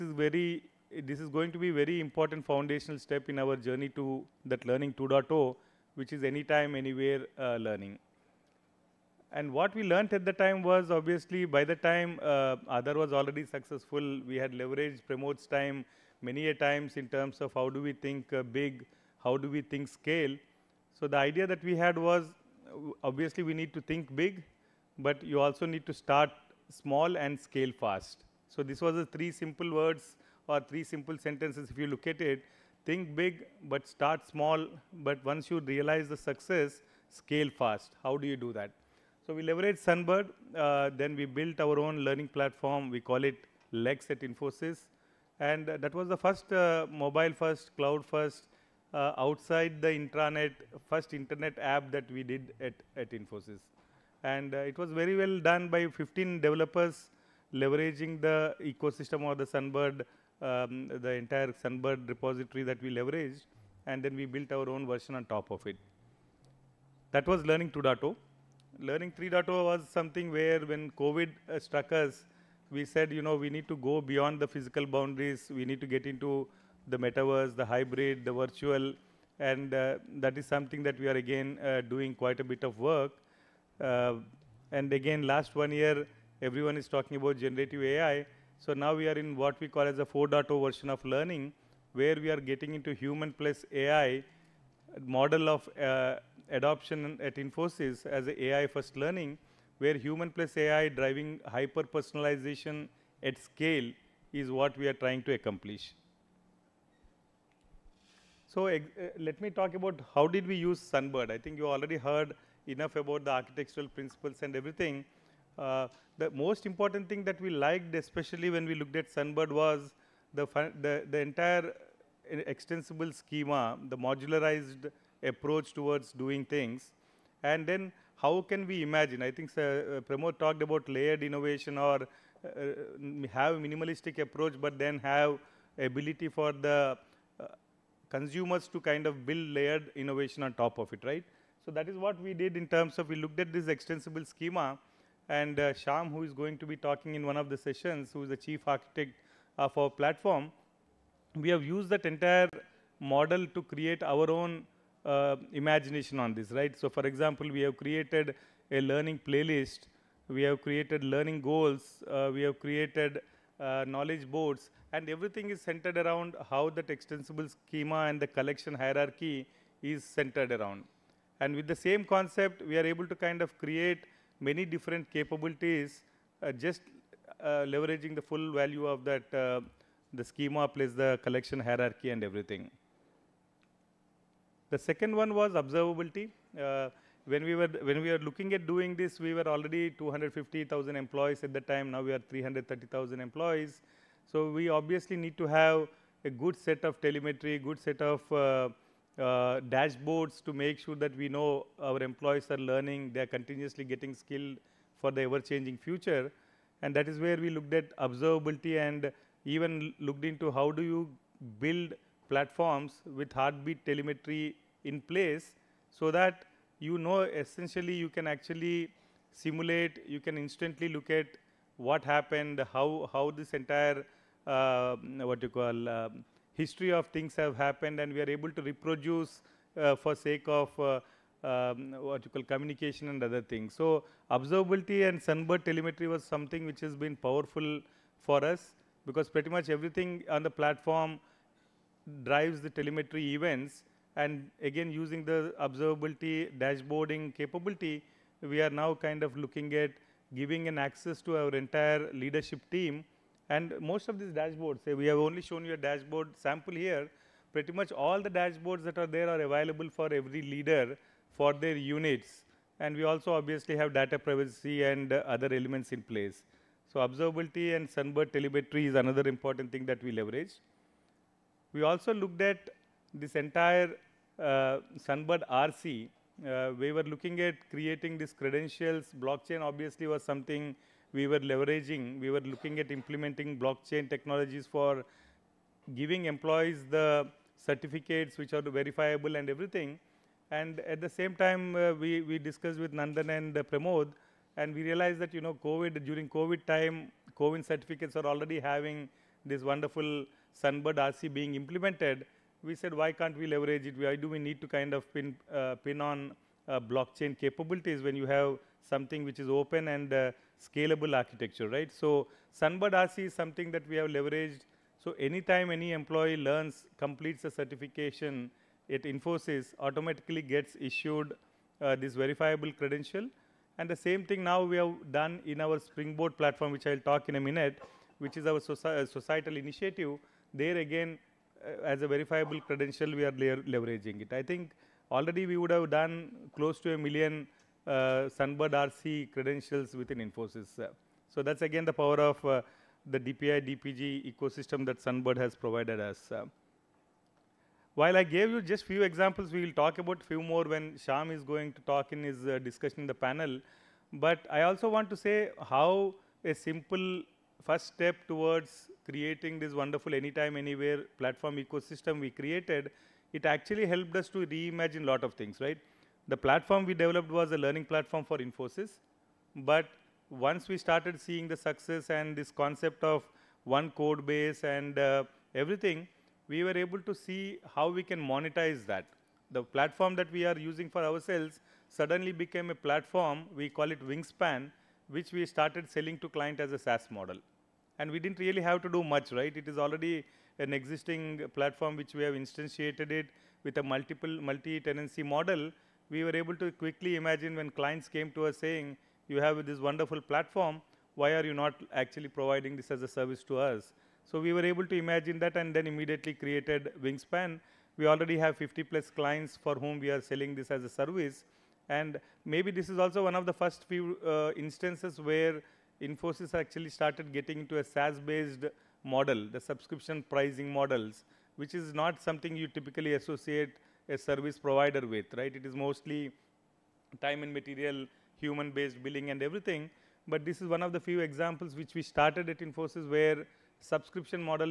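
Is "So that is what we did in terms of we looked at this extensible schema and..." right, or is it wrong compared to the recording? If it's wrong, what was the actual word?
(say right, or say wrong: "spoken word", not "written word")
right.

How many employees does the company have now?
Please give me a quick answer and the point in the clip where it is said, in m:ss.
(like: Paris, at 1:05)
330,000, at 3:12.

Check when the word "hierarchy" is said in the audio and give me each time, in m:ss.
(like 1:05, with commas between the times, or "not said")
2:48, 3:01.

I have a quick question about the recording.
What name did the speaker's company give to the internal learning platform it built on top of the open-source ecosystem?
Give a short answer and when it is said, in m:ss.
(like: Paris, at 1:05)
Lex, at 0:43.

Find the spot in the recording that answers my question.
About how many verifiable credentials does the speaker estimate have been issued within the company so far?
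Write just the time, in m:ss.
5:36.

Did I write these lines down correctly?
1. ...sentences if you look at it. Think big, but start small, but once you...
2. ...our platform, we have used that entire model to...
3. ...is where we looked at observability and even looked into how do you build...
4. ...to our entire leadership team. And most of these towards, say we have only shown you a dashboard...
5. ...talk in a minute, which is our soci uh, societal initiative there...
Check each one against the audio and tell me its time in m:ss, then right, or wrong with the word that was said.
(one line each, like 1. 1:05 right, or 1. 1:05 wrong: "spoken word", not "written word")
1. 0:31 right
2. 2:29 right
3. 3:27 right
4. 4:11 wrong: "dashboards", not "towards"
5. 5:26 right.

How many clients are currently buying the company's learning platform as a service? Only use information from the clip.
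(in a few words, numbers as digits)
50 plus.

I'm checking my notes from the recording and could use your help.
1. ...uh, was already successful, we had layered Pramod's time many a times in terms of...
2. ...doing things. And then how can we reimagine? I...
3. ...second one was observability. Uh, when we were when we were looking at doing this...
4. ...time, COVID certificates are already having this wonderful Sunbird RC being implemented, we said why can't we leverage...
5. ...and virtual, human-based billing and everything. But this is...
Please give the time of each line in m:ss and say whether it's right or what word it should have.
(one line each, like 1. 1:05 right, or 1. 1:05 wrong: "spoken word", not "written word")
1. 0:12 wrong: "leveraged", not "layered"
2. 2:06 wrong: "imagine", not "reimagine"
3. 3:04 right
4. 4:56 right
5. 7:07 wrong: "material", not "virtual".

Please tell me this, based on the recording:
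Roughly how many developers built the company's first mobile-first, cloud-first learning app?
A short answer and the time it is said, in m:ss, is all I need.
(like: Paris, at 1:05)
15, at 0:55.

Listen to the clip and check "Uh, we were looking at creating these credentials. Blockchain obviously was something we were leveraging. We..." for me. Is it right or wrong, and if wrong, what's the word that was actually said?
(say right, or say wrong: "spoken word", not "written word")
right.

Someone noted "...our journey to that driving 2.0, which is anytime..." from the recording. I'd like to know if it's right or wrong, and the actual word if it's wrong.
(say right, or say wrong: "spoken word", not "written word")
wrong: "learning", not "driving".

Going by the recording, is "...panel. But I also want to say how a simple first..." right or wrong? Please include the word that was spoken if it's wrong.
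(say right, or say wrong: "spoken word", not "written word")
right.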